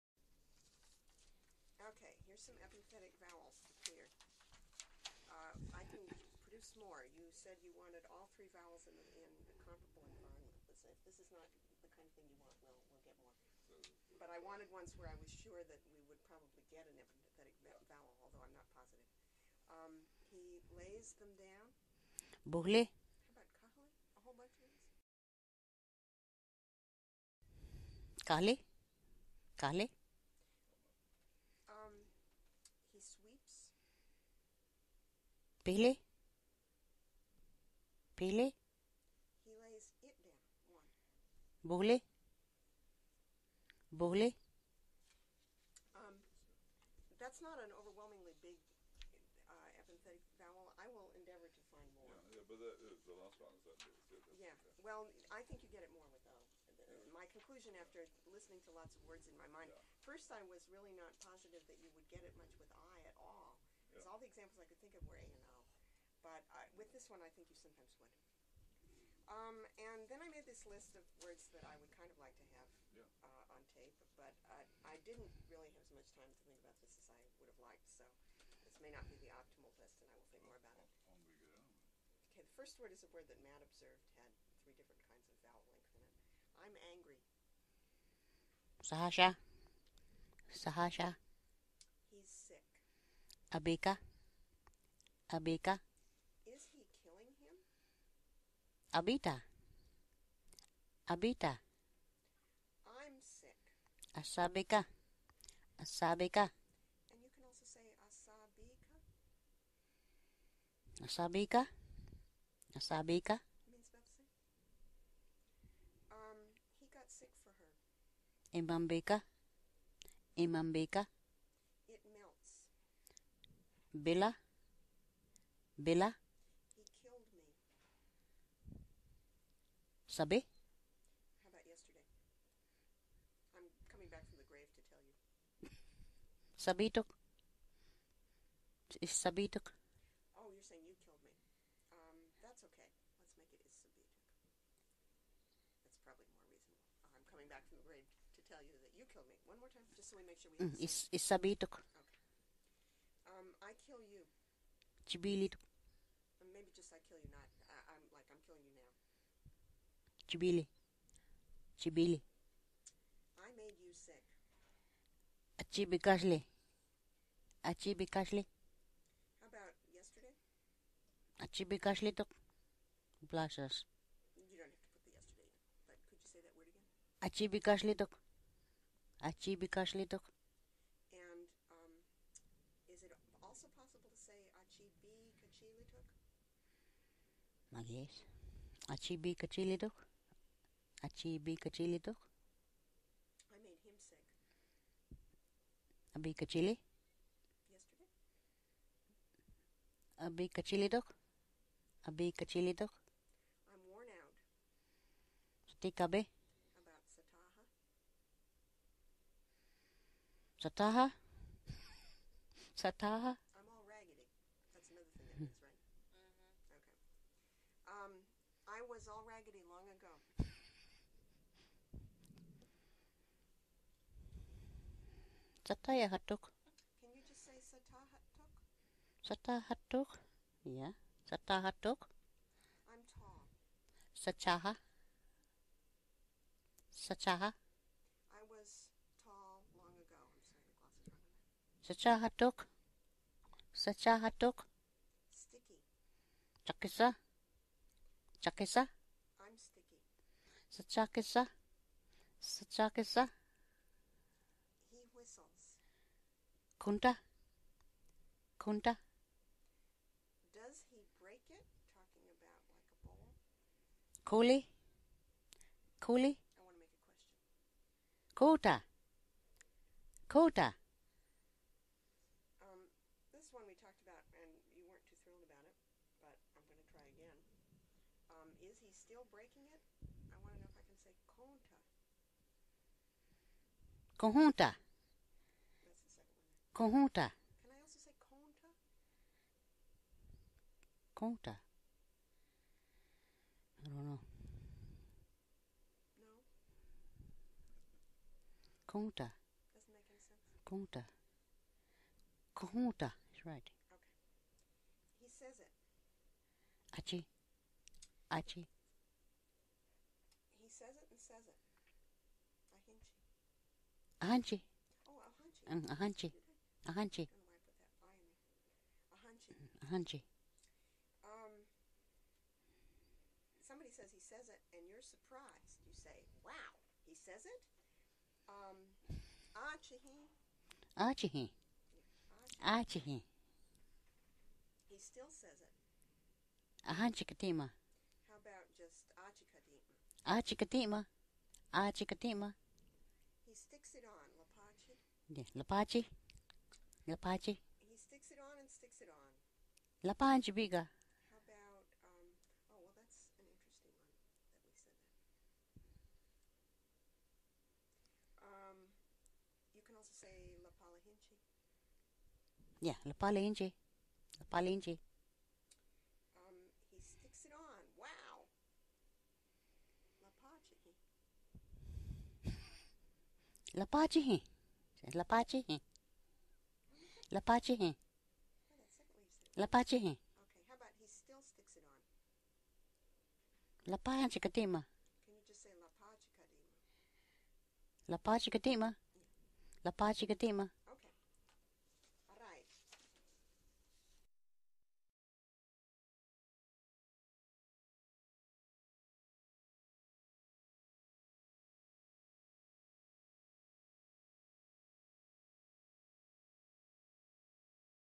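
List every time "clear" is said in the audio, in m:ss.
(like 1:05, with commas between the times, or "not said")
0:03.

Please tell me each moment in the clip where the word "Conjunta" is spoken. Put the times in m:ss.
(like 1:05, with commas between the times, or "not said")
4:46, 5:02.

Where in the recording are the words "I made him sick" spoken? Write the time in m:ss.
3:12.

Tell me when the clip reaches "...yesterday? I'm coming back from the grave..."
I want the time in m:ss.
2:11.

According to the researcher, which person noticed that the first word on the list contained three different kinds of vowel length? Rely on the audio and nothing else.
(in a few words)
Matt.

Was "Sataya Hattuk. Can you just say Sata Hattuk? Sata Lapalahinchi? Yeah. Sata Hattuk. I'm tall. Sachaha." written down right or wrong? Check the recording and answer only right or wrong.
wrong.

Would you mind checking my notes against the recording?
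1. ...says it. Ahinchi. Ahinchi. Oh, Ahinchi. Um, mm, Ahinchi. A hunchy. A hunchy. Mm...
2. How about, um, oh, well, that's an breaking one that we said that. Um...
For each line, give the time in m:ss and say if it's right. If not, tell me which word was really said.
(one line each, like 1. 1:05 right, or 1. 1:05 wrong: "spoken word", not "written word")
1. 5:11 right
2. 5:50 wrong: "interesting", not "breaking".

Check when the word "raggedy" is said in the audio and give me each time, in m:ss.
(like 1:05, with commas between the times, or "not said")
3:33, 3:39.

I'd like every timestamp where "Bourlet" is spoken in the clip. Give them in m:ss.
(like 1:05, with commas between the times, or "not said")
0:22.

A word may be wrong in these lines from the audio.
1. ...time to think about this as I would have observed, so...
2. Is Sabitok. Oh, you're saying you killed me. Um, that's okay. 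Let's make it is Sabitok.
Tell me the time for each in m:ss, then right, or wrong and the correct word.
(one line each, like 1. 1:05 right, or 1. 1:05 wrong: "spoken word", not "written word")
1. 1:16 wrong: "liked", not "observed"
2. 2:18 right.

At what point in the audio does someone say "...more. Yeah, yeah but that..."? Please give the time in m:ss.
0:51.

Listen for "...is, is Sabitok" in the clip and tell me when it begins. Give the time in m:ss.
2:30.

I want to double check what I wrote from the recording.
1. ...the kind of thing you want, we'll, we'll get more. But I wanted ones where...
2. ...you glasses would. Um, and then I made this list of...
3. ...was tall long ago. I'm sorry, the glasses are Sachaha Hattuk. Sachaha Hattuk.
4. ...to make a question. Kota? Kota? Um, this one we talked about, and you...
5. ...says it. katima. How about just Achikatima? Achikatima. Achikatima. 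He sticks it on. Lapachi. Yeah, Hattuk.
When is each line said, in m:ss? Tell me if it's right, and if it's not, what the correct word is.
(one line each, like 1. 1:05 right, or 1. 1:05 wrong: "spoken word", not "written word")
1. 0:11 right
2. 1:07 wrong: "sometimes", not "glasses"
3. 3:58 right
4. 4:26 right
5. 5:35 wrong: "Lapachi", not "Hattuk".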